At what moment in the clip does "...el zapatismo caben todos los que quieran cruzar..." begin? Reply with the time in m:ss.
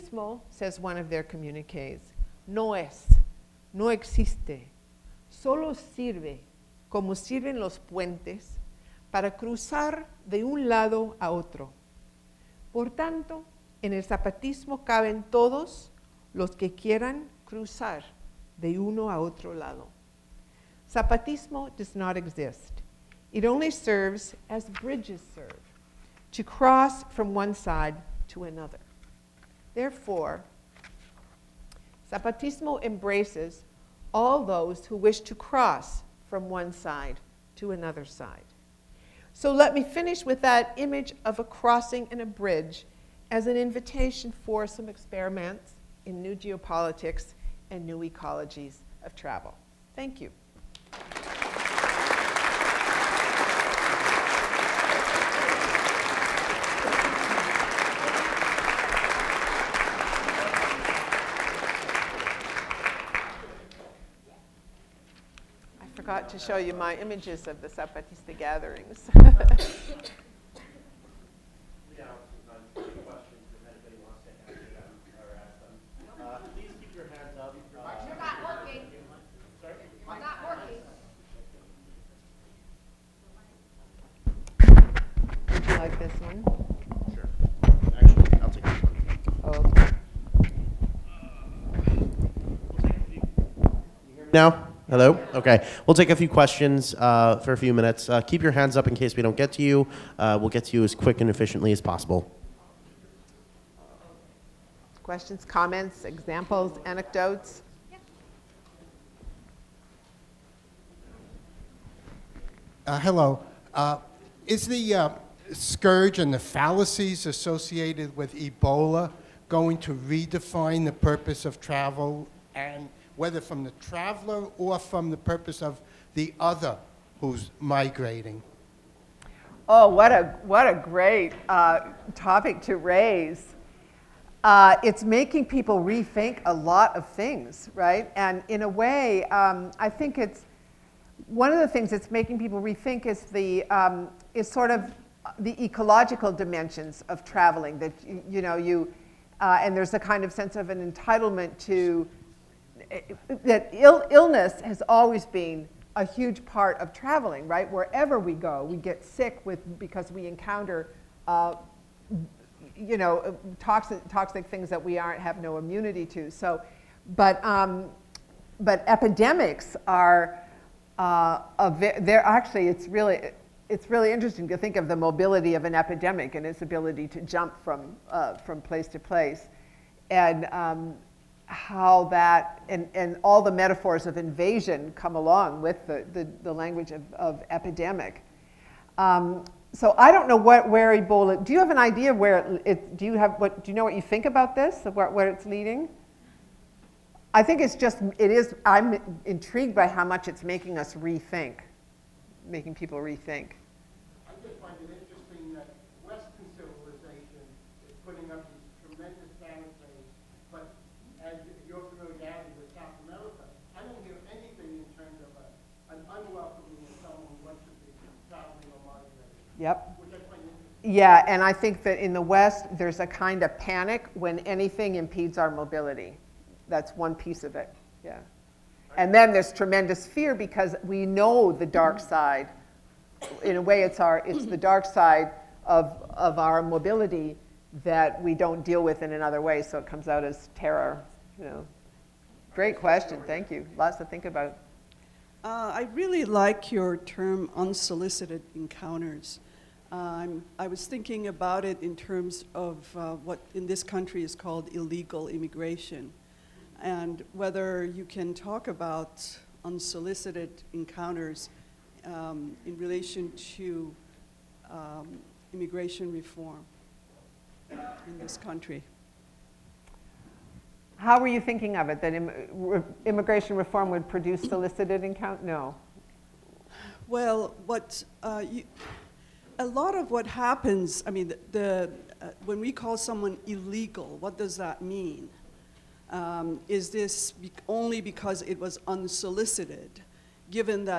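0:13.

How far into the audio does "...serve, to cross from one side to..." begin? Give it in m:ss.
0:25.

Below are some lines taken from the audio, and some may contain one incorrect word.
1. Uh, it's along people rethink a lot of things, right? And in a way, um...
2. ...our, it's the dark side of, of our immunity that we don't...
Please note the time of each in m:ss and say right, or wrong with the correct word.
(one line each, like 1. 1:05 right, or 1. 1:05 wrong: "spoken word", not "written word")
1. 2:14 wrong: "making", not "along"
2. 3:53 wrong: "mobility", not "immunity".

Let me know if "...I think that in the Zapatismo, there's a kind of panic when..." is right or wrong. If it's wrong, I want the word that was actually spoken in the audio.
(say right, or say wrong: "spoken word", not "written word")
wrong: "West", not "Zapatismo".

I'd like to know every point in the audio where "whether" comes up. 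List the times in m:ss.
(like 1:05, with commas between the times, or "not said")
2:03, 4:17.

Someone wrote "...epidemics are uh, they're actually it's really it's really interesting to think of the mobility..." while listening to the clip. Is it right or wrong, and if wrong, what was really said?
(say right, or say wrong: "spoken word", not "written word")
right.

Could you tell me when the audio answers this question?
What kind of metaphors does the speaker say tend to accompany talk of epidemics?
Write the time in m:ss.
3:03.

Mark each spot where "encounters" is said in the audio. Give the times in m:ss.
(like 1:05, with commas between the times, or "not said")
2:40, 4:08, 4:20, 4:35.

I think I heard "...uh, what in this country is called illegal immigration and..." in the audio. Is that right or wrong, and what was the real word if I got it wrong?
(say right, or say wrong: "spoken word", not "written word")
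right.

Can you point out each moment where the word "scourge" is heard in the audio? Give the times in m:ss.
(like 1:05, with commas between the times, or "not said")
1:55.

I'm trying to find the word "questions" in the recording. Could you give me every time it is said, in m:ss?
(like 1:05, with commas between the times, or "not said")
1:36, 1:45, 4:02.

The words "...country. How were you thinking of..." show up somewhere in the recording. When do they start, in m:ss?
4:28.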